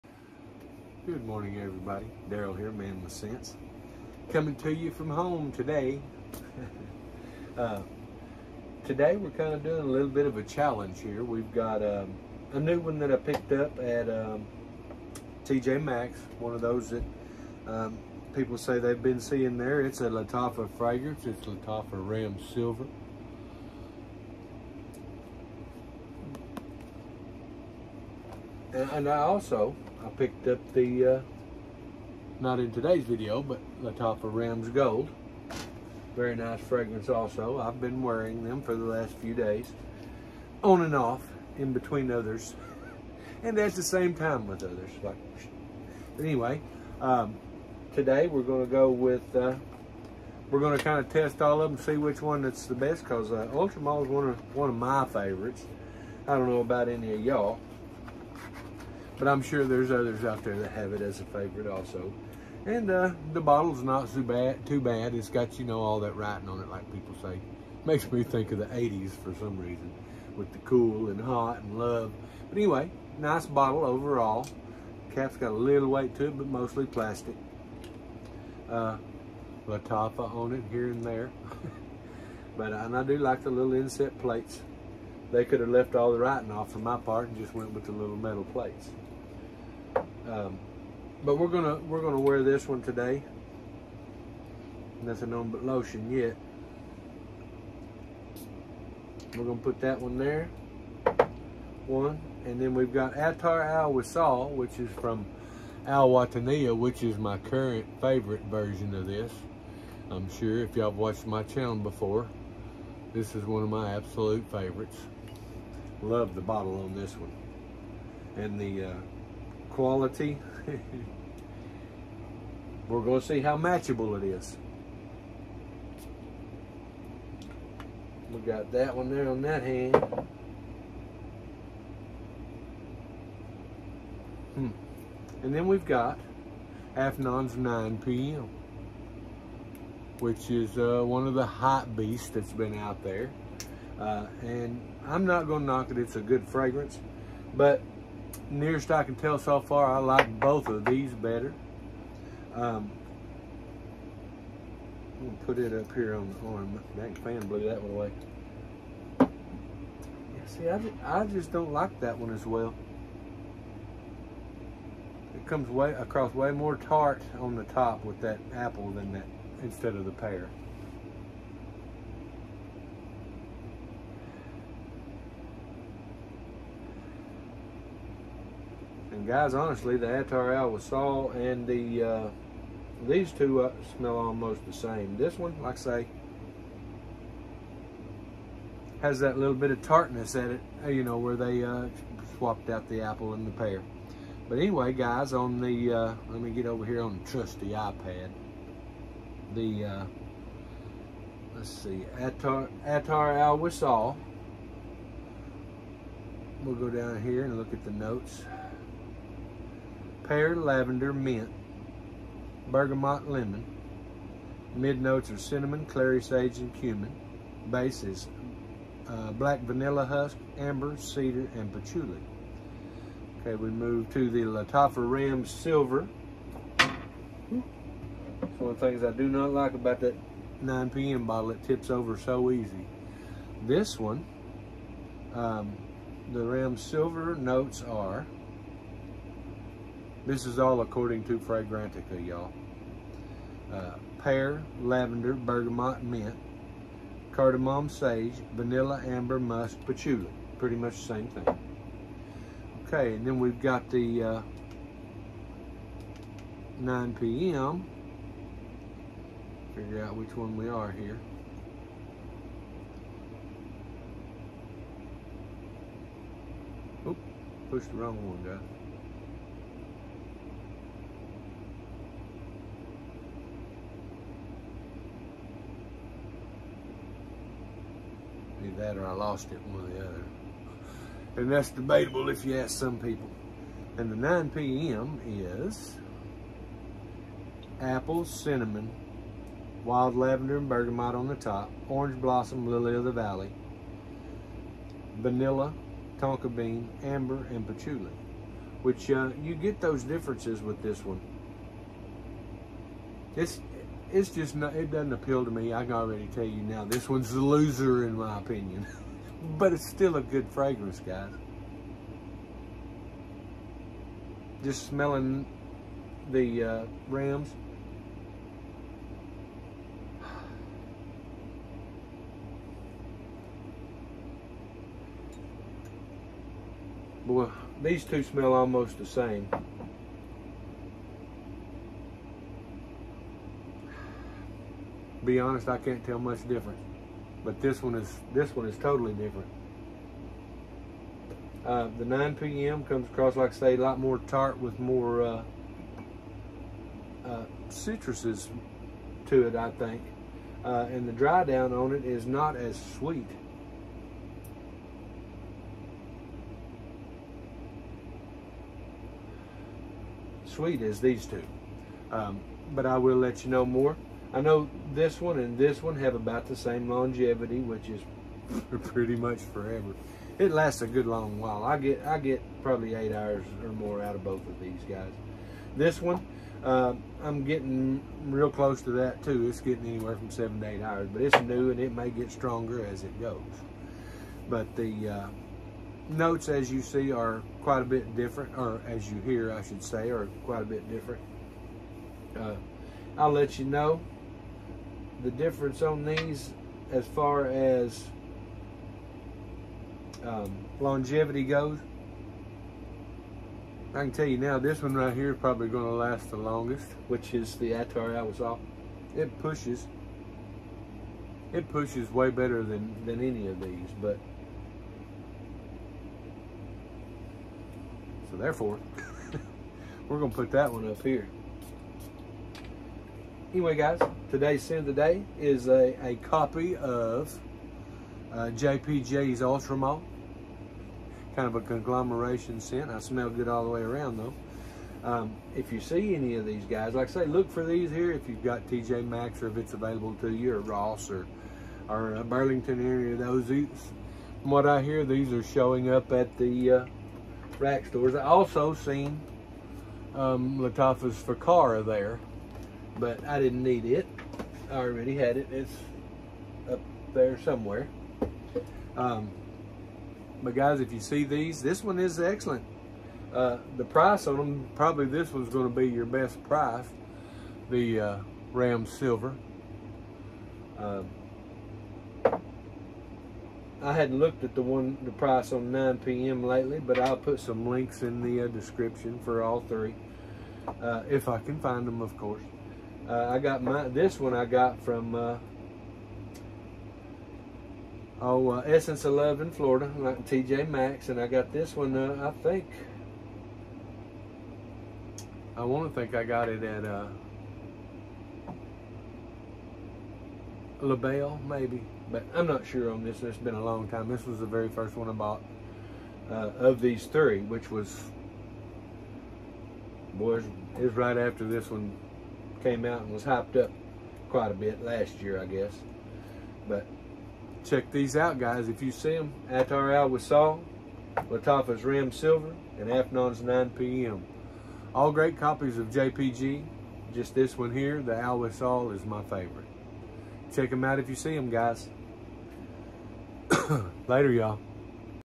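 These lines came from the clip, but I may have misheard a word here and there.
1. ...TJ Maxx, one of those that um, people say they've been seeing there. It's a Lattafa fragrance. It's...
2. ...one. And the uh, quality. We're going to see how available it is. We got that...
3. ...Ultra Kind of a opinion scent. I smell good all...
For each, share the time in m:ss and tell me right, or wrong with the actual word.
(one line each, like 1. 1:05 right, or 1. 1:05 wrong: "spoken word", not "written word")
1. 0:15 right
2. 1:57 wrong: "matchable", not "available"
3. 7:09 wrong: "conglomeration", not "opinion".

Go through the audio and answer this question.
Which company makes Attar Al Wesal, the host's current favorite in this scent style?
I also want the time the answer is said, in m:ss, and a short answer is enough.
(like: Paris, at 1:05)
Al Wataniah, at 1:45.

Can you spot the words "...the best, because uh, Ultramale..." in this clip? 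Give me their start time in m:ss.
0:52.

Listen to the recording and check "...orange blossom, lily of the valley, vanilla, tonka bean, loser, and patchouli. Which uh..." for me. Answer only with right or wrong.
wrong.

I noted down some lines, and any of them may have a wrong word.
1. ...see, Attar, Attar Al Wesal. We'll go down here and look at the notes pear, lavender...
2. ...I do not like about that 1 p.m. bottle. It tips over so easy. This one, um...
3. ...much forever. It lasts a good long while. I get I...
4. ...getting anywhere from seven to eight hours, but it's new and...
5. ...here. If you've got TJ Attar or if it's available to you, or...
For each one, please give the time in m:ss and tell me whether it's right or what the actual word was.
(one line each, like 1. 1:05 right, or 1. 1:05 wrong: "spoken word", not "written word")
1. 3:21 right
2. 3:49 wrong: "9", not "1"
3. 6:09 right
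4. 6:19 right
5. 7:17 wrong: "Maxx", not "Attar".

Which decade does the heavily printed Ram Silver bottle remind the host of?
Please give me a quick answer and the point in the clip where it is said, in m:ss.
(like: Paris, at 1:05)
The 80s, at 1:08.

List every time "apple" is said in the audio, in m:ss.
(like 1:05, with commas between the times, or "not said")
2:48, 3:13, 4:47.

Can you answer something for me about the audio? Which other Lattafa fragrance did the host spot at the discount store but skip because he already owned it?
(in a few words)
Fakara.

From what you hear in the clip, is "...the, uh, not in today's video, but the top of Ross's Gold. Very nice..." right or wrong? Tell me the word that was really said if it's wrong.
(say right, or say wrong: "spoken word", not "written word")
wrong: "Ram", not "Ross".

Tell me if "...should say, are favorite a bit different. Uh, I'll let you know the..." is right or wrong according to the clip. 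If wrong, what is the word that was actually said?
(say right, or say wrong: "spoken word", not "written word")
wrong: "quite", not "favorite".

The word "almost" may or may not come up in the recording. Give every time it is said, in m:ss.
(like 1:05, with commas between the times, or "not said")
3:04, 5:28.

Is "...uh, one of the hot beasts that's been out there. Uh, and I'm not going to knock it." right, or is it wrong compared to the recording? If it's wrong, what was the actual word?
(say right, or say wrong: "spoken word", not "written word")
right.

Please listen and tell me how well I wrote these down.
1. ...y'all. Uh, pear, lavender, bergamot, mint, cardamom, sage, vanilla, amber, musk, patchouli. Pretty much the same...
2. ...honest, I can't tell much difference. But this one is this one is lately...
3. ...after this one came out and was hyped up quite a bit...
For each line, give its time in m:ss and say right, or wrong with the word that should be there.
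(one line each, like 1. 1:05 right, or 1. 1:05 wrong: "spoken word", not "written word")
1. 4:02 right
2. 5:35 wrong: "totally", not "lately"
3. 8:31 right.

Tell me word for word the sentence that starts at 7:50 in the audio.
Um, I hadn't looked at the one, the price on 9 p.m.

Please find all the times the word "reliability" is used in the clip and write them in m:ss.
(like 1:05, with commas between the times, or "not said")
not said.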